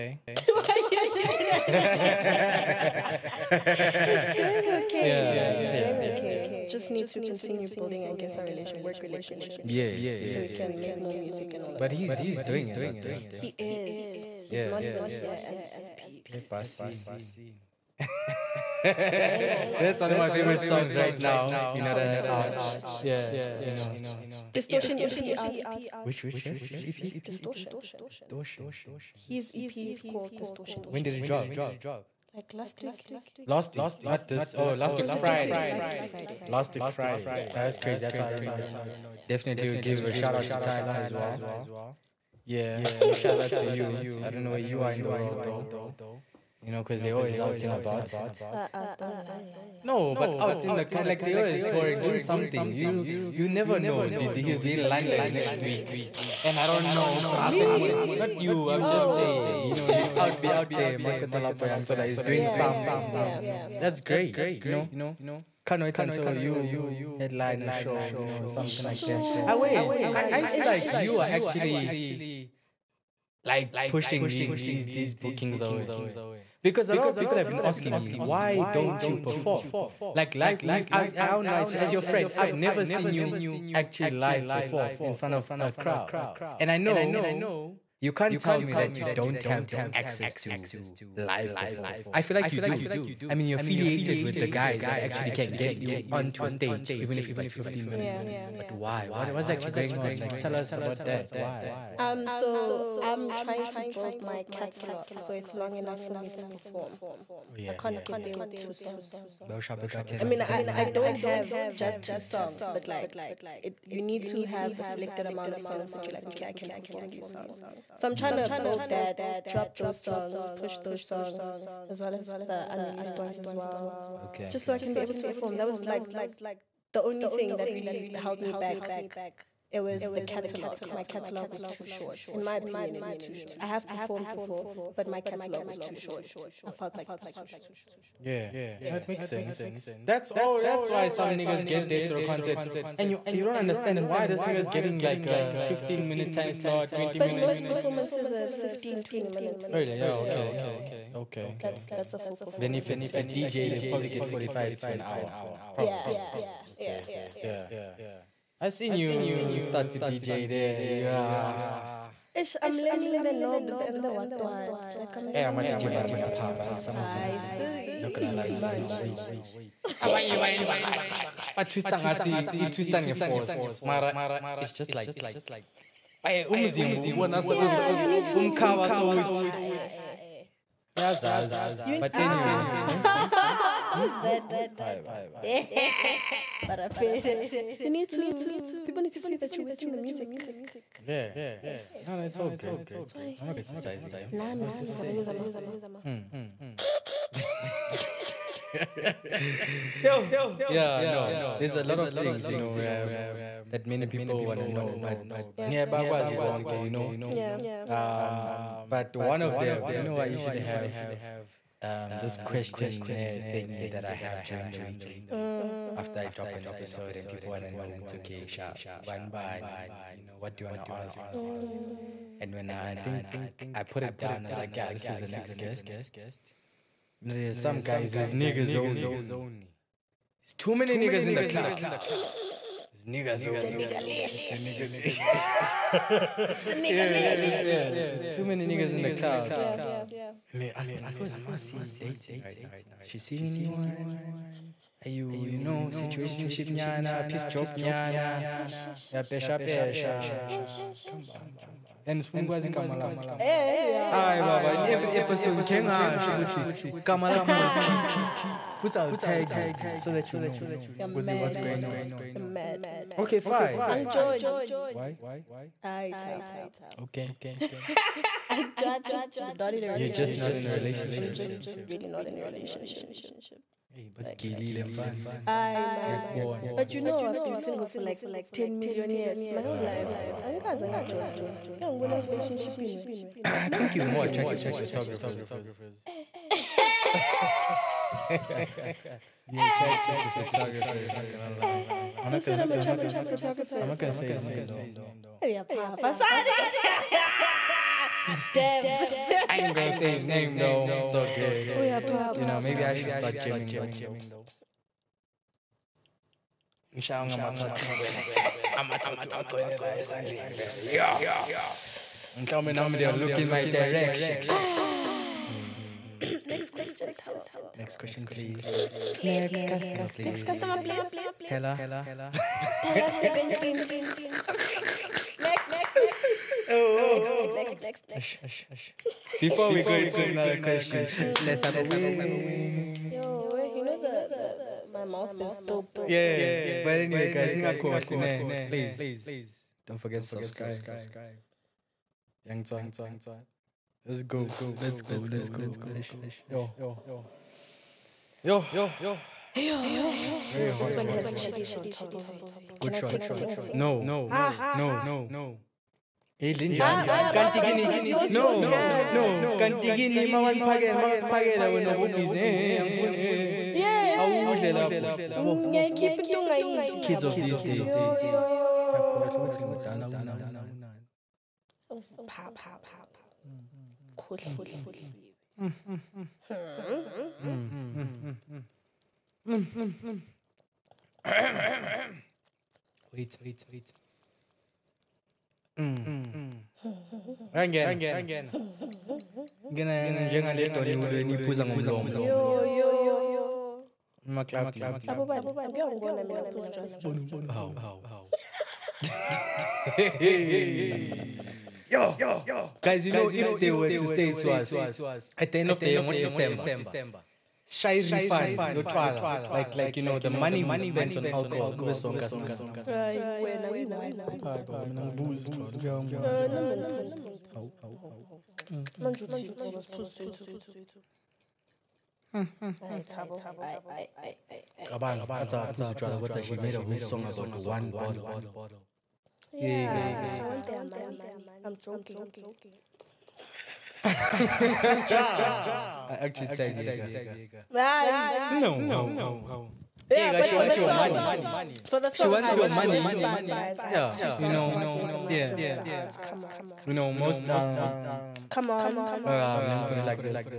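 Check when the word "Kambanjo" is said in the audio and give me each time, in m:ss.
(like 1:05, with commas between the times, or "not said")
4:11.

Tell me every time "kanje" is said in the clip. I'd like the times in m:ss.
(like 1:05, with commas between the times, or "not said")
2:50.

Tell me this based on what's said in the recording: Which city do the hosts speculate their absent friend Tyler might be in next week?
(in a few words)
London.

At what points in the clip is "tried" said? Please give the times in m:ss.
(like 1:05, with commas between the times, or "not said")
0:40.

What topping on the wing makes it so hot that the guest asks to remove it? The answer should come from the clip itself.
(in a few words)
Chilies.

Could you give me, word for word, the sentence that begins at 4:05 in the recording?
Are you, you know, situationship nyana, peace job nyana?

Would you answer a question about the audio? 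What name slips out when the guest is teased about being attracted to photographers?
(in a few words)
Dev.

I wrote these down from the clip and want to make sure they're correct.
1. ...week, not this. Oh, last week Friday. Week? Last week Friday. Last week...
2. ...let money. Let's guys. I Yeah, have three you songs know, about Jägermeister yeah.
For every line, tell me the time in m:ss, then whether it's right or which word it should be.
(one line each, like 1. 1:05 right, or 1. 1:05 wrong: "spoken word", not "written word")
1. 0:33 right
2. 7:22 wrong: "two", not "three".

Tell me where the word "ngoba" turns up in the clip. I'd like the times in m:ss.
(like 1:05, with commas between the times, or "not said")
6:59.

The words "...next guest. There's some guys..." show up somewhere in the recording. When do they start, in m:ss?
3:45.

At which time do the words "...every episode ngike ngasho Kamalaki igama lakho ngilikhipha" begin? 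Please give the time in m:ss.
4:14.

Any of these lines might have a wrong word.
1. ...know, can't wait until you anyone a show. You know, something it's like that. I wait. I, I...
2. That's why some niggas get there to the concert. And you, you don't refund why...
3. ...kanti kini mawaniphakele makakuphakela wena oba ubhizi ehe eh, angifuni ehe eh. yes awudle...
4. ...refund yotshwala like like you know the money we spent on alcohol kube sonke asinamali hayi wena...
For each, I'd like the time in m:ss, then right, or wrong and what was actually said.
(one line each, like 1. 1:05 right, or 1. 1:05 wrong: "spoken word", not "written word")
1. 1:04 wrong: "headline", not "anyone"
2. 2:20 wrong: "understand", not "refund"
3. 5:59 right
4. 6:48 right.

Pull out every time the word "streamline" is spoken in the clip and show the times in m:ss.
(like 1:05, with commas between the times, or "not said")
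not said.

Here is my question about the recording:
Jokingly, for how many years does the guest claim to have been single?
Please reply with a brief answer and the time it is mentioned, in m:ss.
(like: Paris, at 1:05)
10 million, at 4:38.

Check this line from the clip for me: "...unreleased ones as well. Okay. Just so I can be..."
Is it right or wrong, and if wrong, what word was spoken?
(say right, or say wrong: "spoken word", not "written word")
right.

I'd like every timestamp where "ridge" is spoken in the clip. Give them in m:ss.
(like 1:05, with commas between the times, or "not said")
not said.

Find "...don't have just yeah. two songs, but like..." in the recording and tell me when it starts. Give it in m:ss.
1:50.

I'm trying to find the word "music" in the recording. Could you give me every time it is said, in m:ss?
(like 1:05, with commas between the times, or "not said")
0:11, 3:09.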